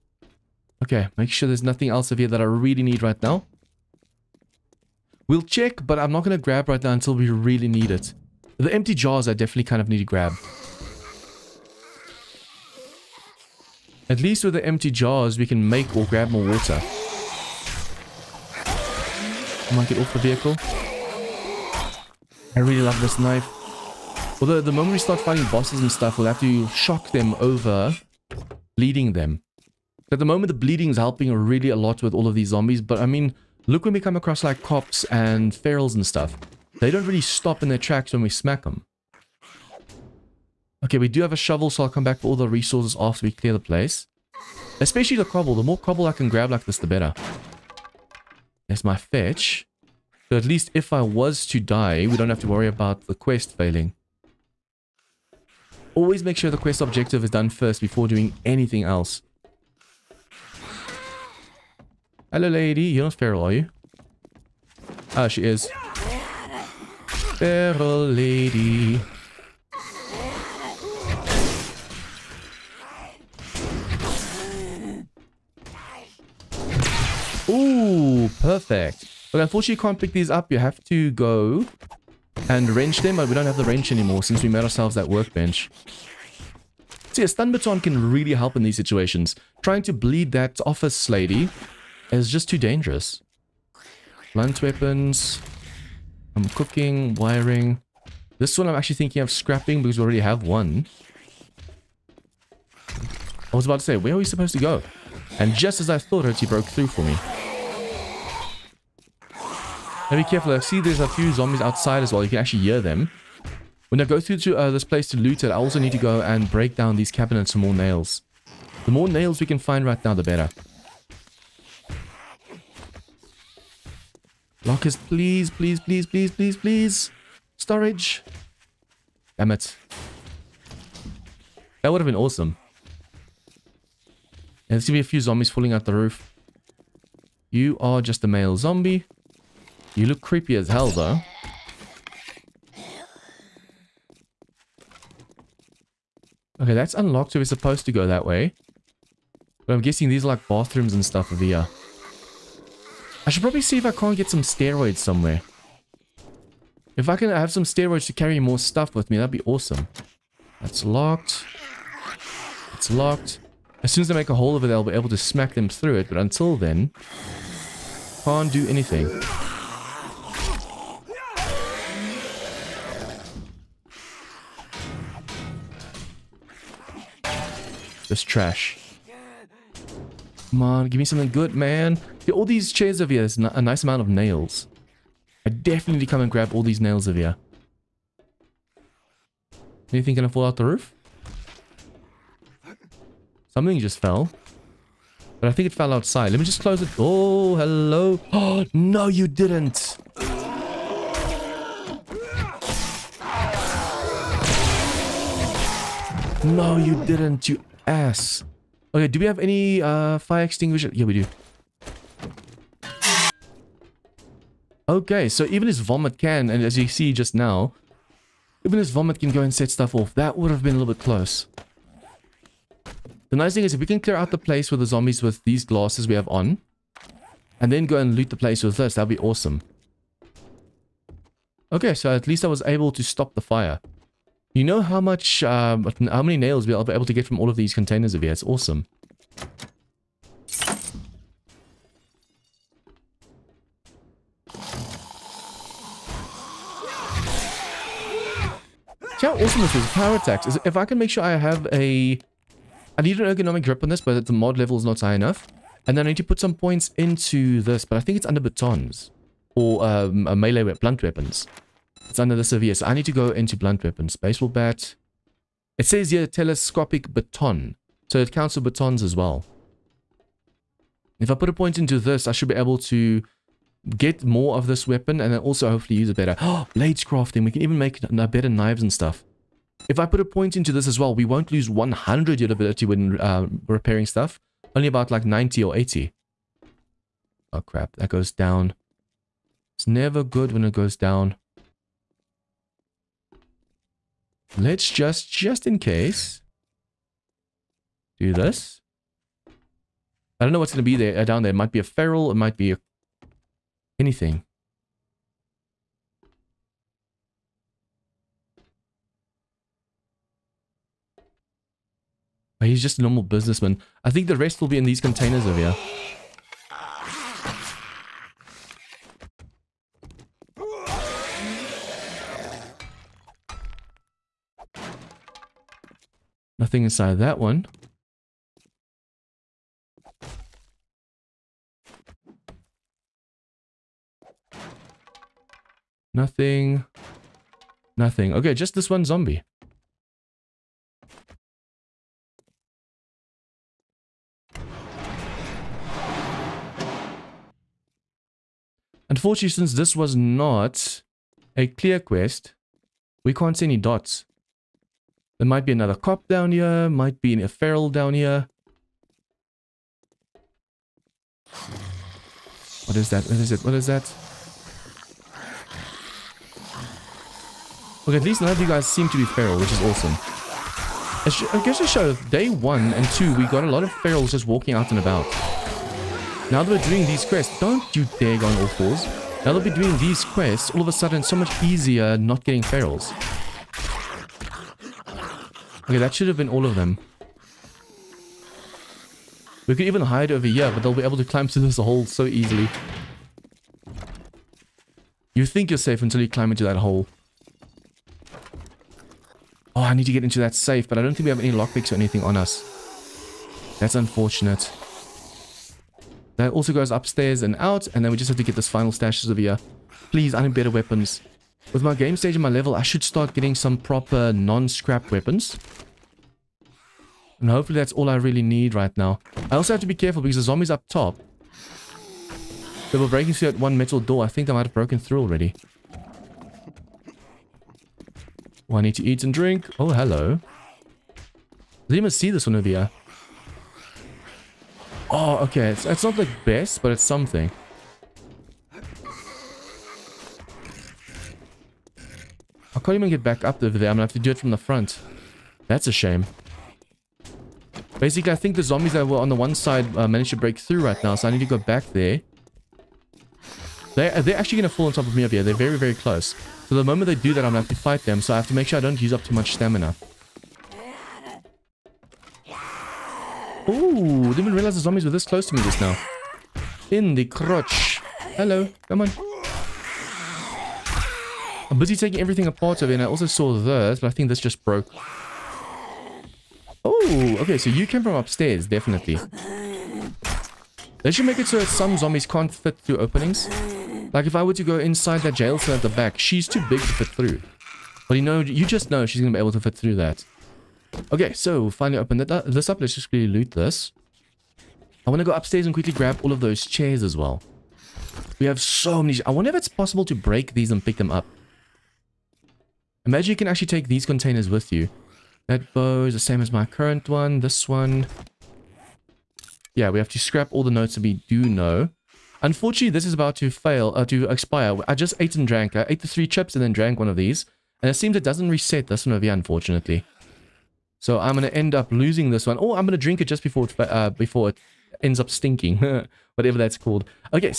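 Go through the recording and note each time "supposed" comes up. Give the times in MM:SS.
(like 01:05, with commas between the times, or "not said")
01:44, 02:27.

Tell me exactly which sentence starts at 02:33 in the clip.
I should probably see if I can't get some steroids somewhere.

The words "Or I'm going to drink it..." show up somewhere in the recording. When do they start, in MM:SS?
08:42.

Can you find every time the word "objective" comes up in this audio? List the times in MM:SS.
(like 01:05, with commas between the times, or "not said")
00:56.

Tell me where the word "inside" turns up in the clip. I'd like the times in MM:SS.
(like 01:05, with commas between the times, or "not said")
05:26, 08:04.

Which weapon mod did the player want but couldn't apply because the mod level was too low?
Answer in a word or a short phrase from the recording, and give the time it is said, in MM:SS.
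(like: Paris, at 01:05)
Ergonomic grip, at 04:13.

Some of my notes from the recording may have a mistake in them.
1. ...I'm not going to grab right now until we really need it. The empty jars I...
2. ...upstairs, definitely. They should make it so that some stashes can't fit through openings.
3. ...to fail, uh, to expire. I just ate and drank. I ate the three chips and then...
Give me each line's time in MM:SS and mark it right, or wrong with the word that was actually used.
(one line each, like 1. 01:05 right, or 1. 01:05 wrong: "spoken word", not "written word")
1. 00:05 right
2. 07:58 wrong: "zombies", not "stashes"
3. 08:33 right.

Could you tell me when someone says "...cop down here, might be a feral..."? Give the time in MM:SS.
05:55.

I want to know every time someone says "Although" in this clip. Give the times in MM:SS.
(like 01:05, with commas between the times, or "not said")
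00:24.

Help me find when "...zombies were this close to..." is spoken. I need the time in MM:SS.
07:44.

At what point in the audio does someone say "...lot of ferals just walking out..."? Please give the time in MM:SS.
06:13.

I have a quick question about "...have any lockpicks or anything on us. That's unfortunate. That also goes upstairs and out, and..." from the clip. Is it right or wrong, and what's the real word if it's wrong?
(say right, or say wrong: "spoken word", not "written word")
right.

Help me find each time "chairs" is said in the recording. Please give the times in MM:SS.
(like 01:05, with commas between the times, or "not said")
03:02, 08:16.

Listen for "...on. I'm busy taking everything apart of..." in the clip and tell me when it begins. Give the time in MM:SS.
07:49.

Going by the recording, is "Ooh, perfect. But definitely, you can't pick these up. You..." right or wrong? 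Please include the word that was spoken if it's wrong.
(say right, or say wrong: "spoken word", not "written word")
wrong: "unfortunately", not "definitely".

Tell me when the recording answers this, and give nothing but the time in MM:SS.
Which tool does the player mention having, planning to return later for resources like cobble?
00:41.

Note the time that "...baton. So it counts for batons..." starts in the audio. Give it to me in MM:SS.
04:27.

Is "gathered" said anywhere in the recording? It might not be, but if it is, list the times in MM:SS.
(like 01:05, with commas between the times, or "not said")
not said.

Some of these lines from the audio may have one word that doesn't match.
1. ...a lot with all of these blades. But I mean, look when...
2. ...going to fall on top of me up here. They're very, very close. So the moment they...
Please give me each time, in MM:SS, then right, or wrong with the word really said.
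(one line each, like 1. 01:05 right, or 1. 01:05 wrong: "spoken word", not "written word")
1. 00:31 wrong: "zombies", not "blades"
2. 07:34 right.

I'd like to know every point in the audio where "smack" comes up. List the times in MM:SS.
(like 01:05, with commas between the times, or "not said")
00:38, 02:45.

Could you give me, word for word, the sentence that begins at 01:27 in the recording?
So yeah, stun baton can really help in these situations.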